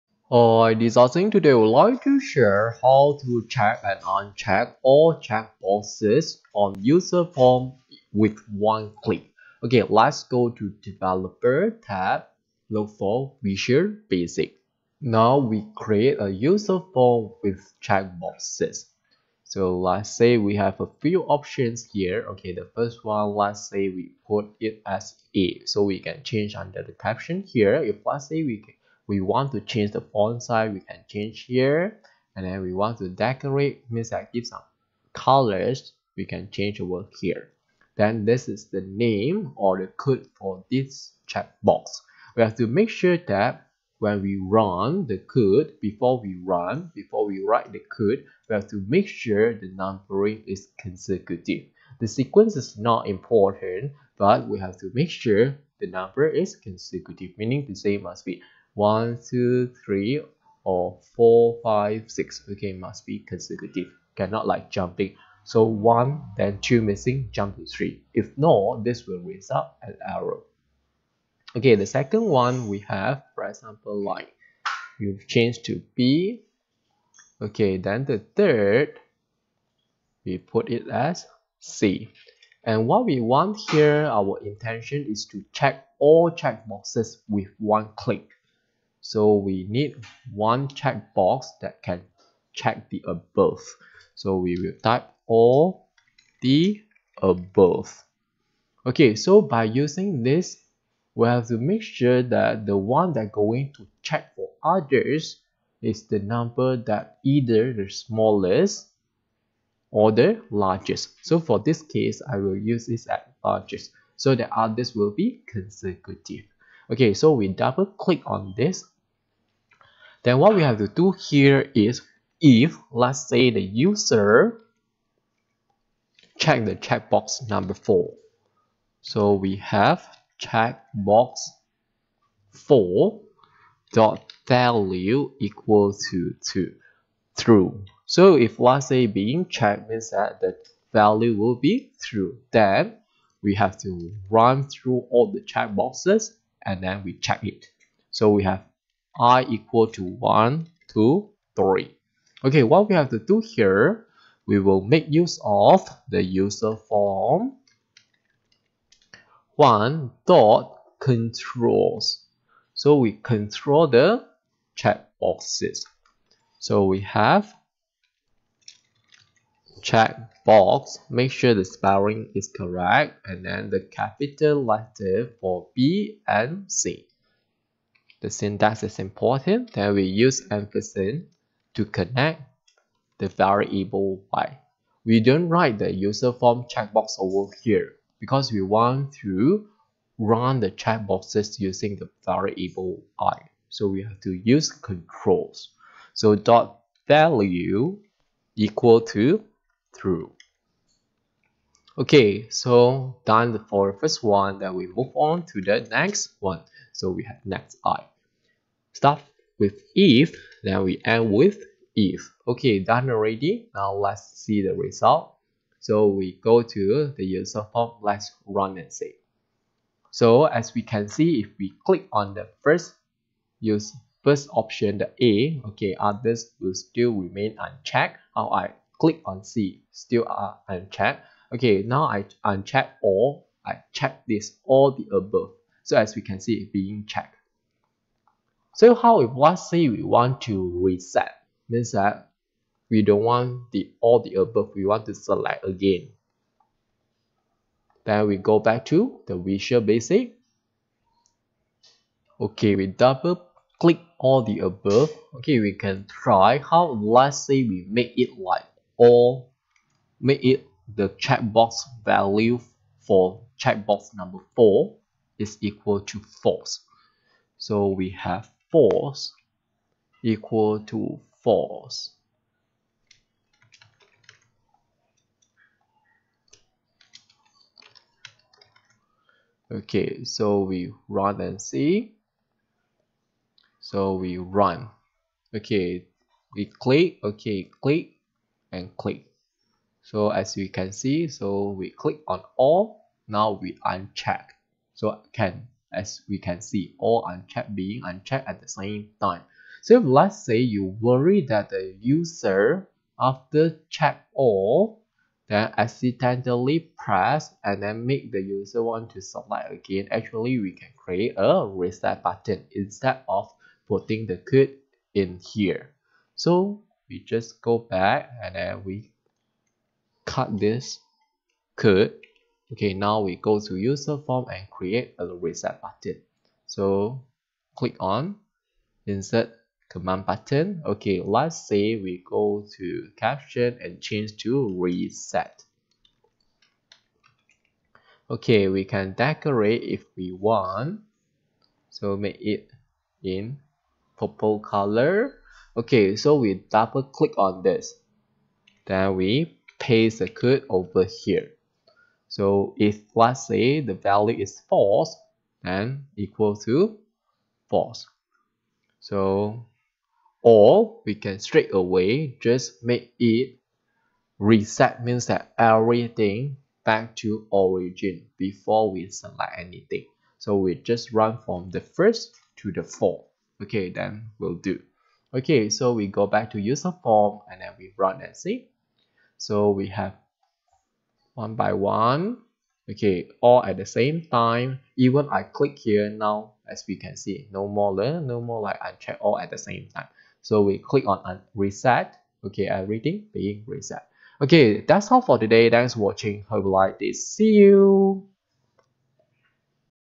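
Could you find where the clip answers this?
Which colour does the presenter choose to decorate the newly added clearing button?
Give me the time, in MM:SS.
05:44.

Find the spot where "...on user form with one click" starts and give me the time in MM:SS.
00:06.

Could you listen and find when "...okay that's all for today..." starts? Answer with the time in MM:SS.
06:34.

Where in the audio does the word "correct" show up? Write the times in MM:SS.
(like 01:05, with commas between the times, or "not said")
02:52.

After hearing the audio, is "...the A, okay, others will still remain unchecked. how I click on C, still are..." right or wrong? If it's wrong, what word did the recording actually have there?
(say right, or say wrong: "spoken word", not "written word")
right.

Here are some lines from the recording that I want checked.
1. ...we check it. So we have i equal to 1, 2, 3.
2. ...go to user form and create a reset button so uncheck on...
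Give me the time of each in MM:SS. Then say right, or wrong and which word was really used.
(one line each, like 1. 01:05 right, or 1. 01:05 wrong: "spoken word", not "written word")
1. 02:27 right
2. 05:23 wrong: "click", not "uncheck".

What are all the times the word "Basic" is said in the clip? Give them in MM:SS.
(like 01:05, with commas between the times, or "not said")
00:14, 04:09.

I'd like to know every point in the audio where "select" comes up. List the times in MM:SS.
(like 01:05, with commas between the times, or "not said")
04:05, 05:09, 06:09.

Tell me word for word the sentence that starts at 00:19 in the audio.
So let's say we have a few options here.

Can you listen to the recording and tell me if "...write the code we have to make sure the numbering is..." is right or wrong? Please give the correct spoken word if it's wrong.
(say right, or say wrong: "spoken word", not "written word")
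right.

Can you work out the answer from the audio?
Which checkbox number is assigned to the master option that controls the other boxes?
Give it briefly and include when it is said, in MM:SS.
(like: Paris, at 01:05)
4, at 02:10.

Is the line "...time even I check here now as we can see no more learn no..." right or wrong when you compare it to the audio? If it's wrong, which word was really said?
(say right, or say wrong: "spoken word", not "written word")
wrong: "click", not "check".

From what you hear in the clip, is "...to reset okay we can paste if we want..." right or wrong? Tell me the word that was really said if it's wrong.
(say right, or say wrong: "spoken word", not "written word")
wrong: "decorate", not "paste".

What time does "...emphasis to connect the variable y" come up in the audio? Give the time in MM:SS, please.
03:00.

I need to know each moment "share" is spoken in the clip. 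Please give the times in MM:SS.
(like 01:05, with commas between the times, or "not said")
00:02.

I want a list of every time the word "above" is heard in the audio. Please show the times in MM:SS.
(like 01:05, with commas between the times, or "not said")
01:33, 01:37, 03:55, 04:04, 04:14.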